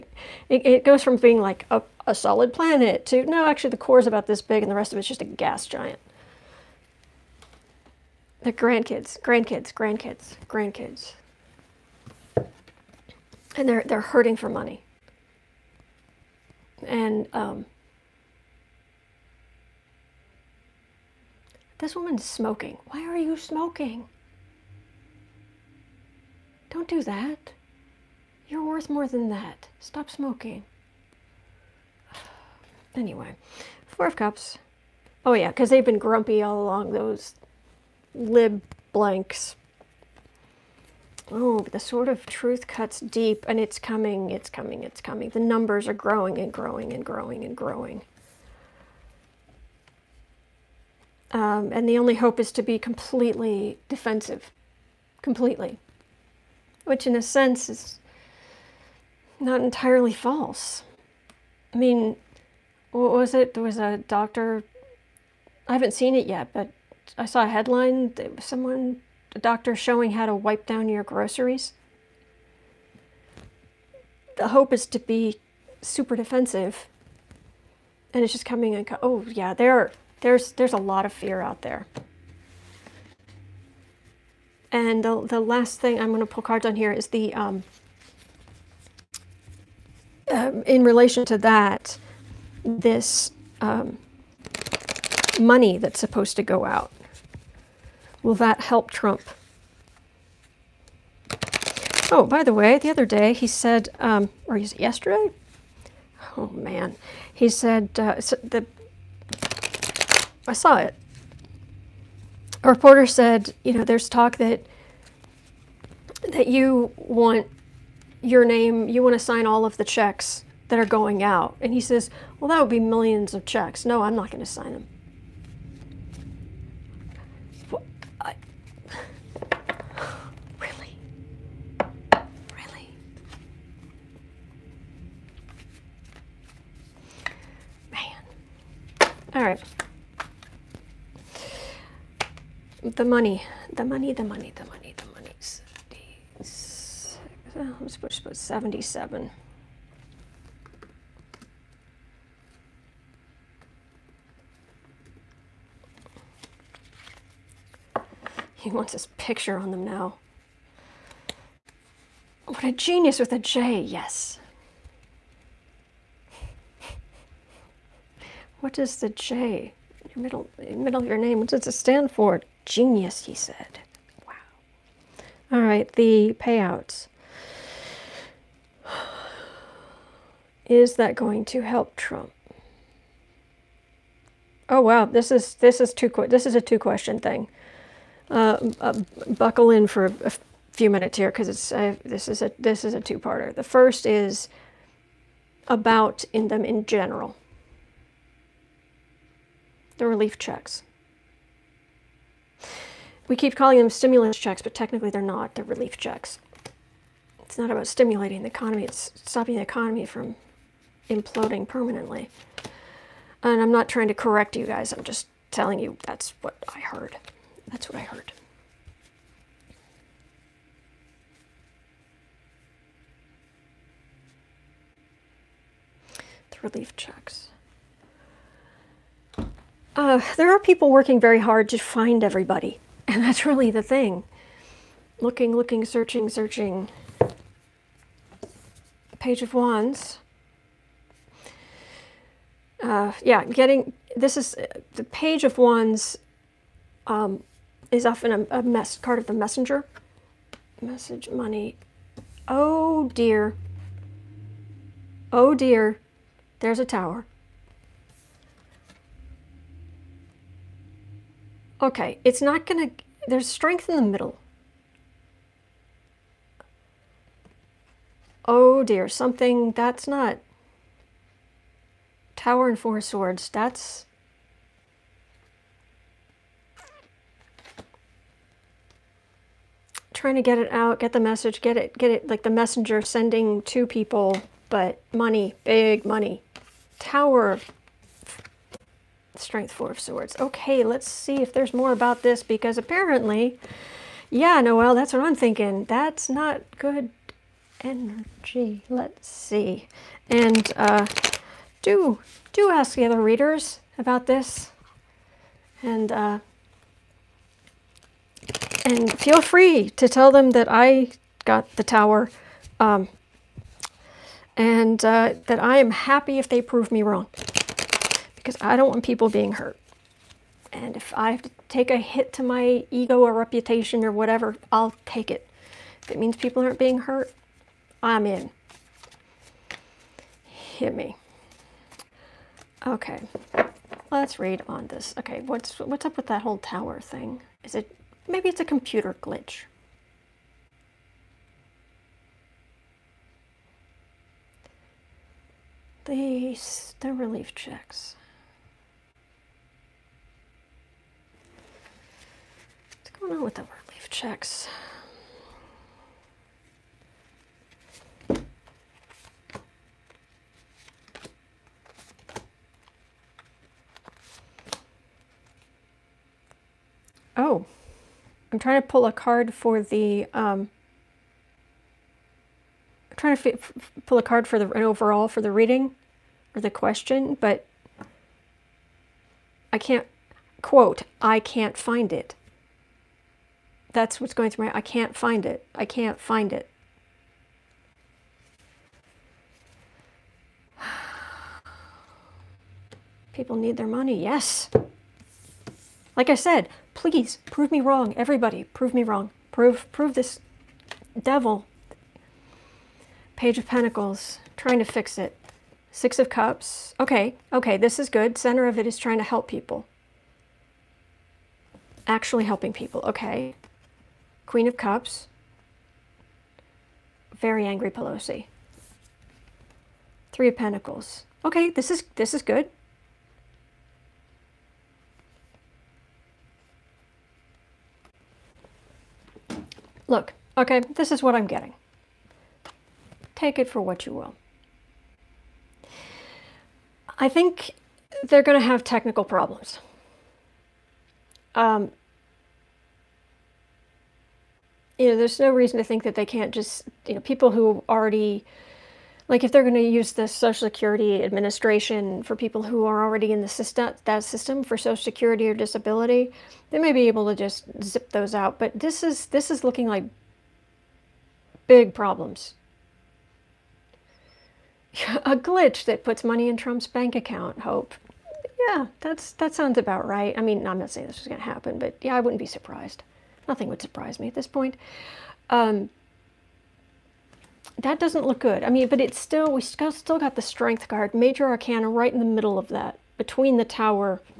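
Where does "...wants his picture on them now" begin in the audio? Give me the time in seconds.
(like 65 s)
158 s.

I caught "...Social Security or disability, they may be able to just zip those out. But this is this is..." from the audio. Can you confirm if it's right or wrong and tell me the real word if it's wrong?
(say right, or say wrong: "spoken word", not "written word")
right.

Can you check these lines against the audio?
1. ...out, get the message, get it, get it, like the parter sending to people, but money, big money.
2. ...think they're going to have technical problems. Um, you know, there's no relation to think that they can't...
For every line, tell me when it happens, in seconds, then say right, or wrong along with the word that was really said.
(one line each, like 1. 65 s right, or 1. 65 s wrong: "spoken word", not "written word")
1. 280 s wrong: "messenger", not "parter"
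2. 437 s wrong: "reason", not "relation".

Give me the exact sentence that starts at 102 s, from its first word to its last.
Oh, by the way, the other day he said, um, or is it yesterday?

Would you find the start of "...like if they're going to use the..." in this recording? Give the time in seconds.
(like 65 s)
449 s.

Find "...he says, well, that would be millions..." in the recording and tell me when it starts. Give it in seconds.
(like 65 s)
121 s.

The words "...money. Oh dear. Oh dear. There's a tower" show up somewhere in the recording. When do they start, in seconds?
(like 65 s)
251 s.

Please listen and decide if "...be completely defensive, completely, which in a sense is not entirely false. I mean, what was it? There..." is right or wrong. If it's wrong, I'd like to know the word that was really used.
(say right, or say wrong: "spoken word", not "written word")
right.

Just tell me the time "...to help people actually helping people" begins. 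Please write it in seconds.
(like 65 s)
409 s.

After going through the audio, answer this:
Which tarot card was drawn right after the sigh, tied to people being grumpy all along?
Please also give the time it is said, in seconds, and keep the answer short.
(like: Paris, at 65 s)
Four of Cups, at 33 s.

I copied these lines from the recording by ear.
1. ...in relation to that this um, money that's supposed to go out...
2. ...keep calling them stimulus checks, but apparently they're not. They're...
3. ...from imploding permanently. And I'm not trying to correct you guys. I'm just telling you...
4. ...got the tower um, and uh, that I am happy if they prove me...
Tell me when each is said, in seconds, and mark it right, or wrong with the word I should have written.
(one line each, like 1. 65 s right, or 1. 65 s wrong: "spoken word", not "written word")
1. 90 s right
2. 203 s wrong: "technically", not "apparently"
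3. 210 s right
4. 311 s right.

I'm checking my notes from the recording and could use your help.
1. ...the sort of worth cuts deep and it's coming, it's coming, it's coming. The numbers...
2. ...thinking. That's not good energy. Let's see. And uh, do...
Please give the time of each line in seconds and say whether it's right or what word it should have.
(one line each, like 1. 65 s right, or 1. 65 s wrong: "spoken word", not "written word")
1. 41 s wrong: "truth", not "worth"
2. 295 s right.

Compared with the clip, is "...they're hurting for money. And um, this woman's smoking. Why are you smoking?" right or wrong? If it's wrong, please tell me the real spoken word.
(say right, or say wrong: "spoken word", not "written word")
right.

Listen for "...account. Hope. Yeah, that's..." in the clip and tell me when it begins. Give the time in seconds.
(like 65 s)
467 s.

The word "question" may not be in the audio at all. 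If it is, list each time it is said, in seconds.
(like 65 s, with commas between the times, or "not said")
186 s, 376 s.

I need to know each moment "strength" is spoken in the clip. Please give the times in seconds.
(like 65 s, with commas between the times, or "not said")
263 s, 289 s, 480 s.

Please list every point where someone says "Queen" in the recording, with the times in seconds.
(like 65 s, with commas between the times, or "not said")
414 s.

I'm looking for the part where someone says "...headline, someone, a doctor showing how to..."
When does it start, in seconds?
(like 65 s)
67 s.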